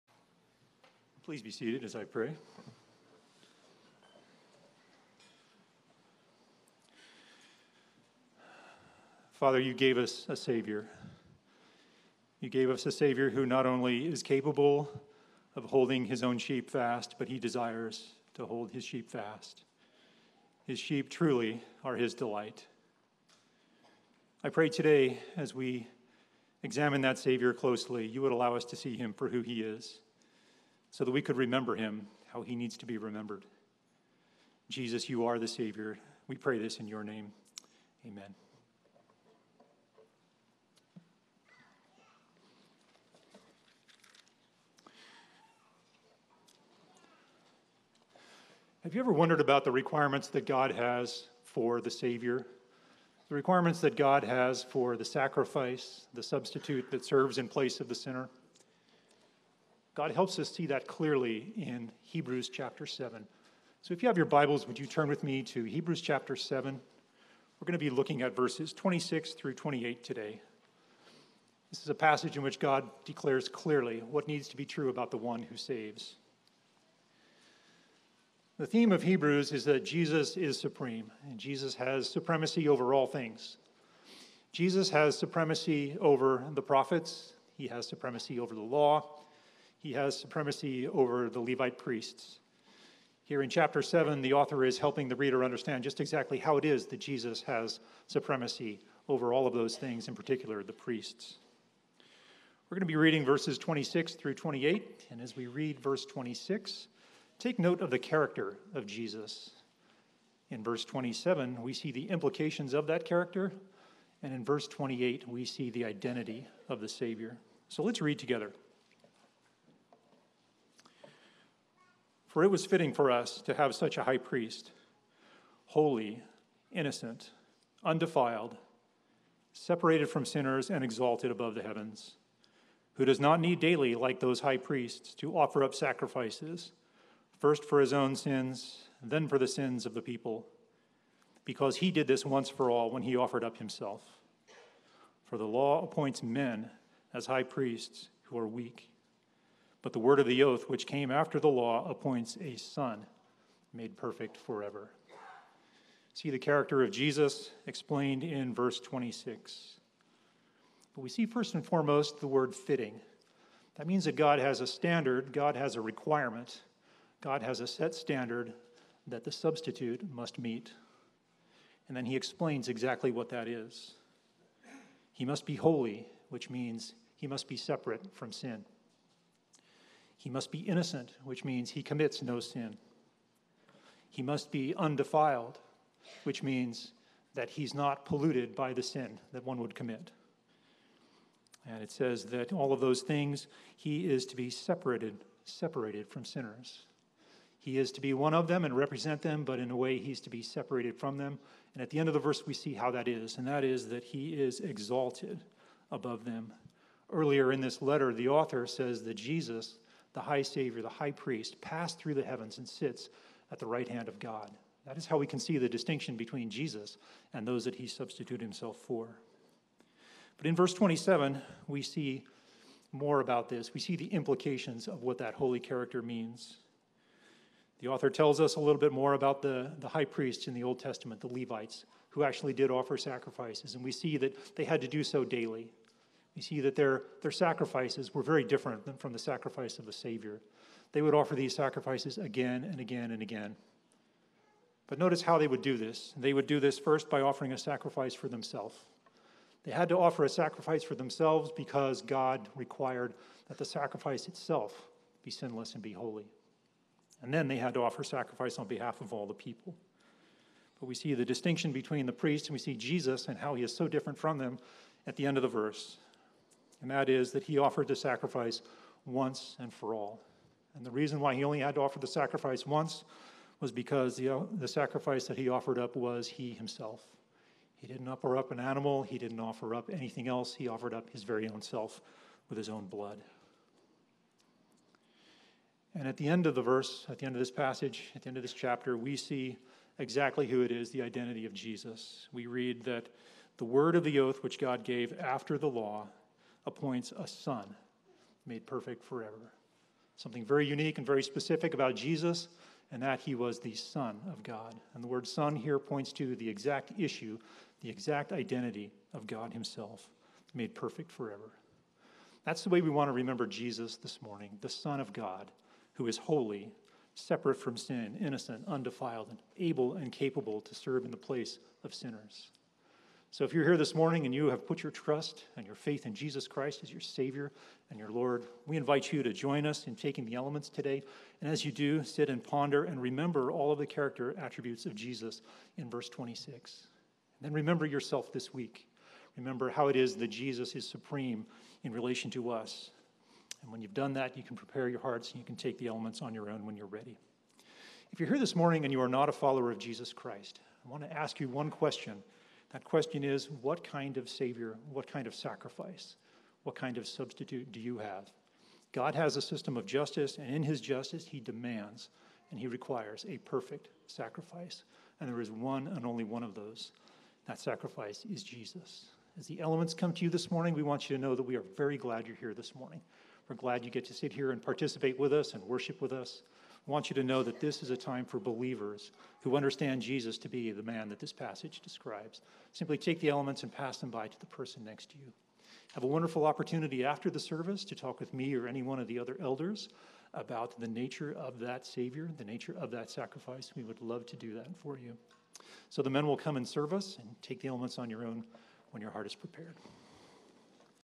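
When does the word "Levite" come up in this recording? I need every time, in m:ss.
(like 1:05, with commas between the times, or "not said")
1:31, 3:51.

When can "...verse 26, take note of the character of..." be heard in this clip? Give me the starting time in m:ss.
1:45.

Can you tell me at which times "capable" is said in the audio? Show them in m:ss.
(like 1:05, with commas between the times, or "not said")
0:14, 5:20.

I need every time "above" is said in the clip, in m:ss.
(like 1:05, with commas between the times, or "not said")
2:11, 3:25.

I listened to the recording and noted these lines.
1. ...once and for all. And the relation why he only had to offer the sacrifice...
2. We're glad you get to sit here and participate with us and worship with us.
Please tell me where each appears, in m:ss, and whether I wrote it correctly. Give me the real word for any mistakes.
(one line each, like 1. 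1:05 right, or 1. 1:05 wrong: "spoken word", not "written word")
1. 4:29 wrong: "reason", not "relation"
2. 6:13 right.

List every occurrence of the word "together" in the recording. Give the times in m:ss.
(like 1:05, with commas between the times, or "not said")
1:58.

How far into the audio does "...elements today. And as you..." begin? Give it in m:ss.
5:30.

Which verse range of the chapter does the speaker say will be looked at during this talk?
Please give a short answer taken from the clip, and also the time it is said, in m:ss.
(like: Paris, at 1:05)
26 through 28, at 1:08.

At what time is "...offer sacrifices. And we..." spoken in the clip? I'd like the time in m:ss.
3:52.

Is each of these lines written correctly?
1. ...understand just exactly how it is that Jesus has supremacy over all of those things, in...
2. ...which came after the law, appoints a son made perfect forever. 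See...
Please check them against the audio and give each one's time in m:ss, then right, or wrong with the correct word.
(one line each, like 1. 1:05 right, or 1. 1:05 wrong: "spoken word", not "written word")
1. 1:35 right
2. 2:30 right.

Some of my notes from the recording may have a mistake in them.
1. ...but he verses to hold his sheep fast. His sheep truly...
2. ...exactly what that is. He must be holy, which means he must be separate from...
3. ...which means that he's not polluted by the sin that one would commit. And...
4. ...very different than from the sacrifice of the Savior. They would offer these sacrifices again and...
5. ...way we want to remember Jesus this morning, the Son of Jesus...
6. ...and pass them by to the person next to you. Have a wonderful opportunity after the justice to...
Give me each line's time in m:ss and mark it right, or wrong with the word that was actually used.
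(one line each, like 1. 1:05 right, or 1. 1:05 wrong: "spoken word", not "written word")
1. 0:17 wrong: "desires", not "verses"
2. 2:52 right
3. 3:06 right
4. 3:58 right
5. 5:12 wrong: "God", not "Jesus"
6. 6:23 wrong: "service", not "justice".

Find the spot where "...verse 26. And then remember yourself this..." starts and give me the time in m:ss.
5:35.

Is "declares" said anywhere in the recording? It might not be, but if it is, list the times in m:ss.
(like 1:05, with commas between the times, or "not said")
1:13.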